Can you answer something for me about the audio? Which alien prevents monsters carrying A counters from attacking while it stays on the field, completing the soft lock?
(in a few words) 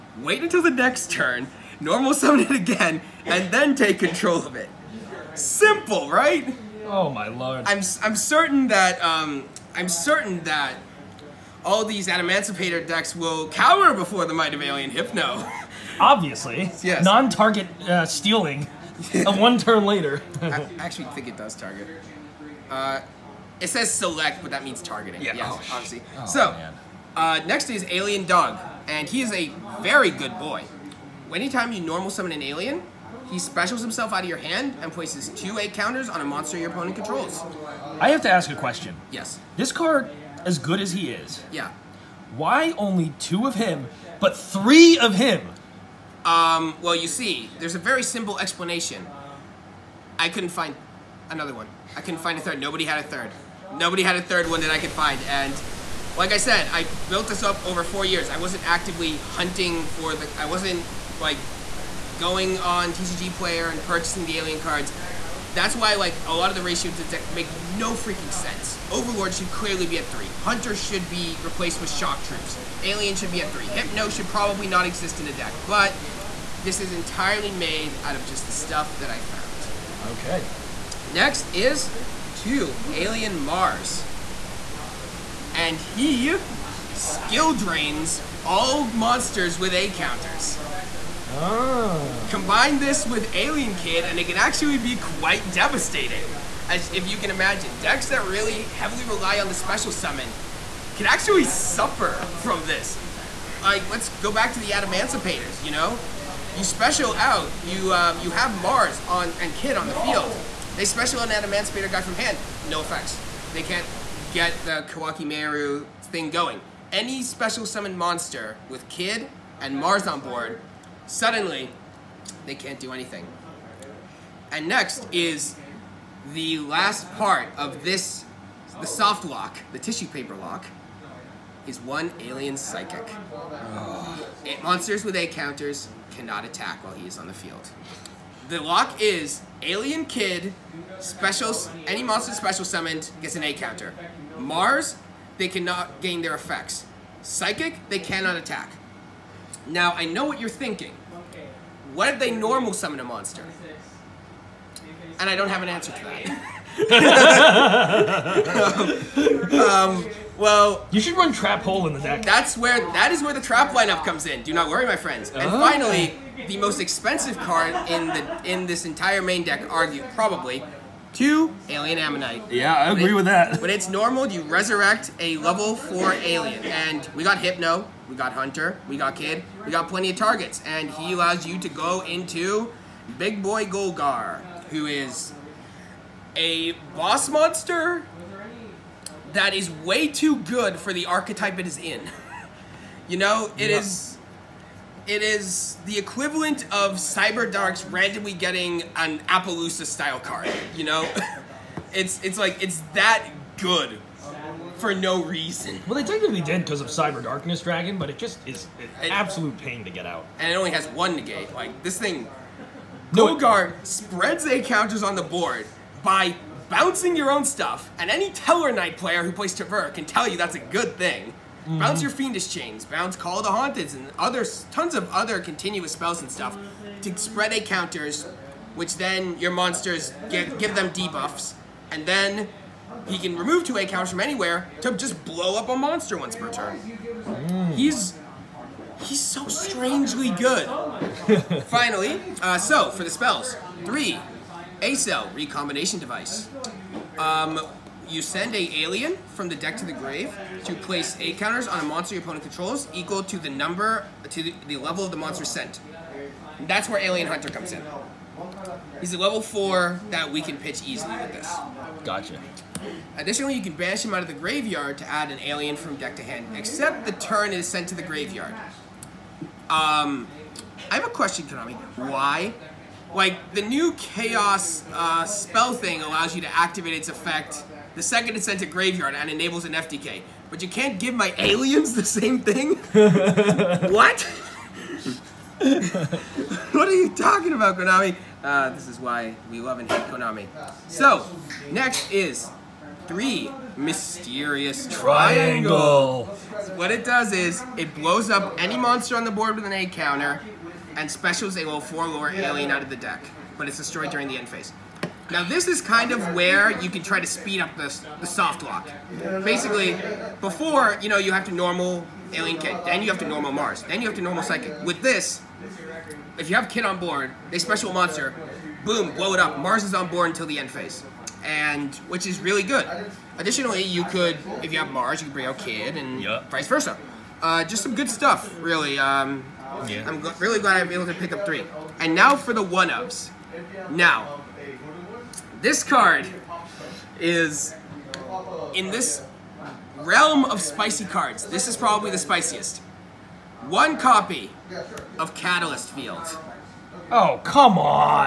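Alien Psychic.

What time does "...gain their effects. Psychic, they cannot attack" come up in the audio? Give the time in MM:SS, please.
02:26.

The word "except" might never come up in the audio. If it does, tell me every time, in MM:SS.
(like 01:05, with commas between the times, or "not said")
04:26.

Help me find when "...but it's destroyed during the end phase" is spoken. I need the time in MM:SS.
05:03.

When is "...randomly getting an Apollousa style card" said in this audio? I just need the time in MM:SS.
03:17.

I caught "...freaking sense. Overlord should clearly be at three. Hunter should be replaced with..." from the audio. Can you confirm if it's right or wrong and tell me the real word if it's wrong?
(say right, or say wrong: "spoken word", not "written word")
right.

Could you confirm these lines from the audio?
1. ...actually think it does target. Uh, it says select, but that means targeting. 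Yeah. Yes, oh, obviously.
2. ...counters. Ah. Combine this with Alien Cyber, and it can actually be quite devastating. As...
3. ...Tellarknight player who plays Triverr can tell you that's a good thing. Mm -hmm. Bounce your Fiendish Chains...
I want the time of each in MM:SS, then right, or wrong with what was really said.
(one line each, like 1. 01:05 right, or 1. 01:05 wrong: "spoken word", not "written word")
1. 00:20 right
2. 01:29 wrong: "Kid", not "Cyber"
3. 03:38 right.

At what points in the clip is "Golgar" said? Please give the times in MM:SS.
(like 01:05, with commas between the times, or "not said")
03:03, 03:33.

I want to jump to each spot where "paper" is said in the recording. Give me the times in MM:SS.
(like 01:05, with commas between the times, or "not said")
02:10.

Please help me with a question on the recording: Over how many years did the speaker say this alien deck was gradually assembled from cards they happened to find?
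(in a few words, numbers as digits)
4.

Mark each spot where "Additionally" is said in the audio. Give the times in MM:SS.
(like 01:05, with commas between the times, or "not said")
04:23, 05:23.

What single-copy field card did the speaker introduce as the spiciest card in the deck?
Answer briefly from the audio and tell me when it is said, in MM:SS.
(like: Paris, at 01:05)
Catalyst Field, at 05:45.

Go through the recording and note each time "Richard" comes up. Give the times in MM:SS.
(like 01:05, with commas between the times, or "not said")
not said.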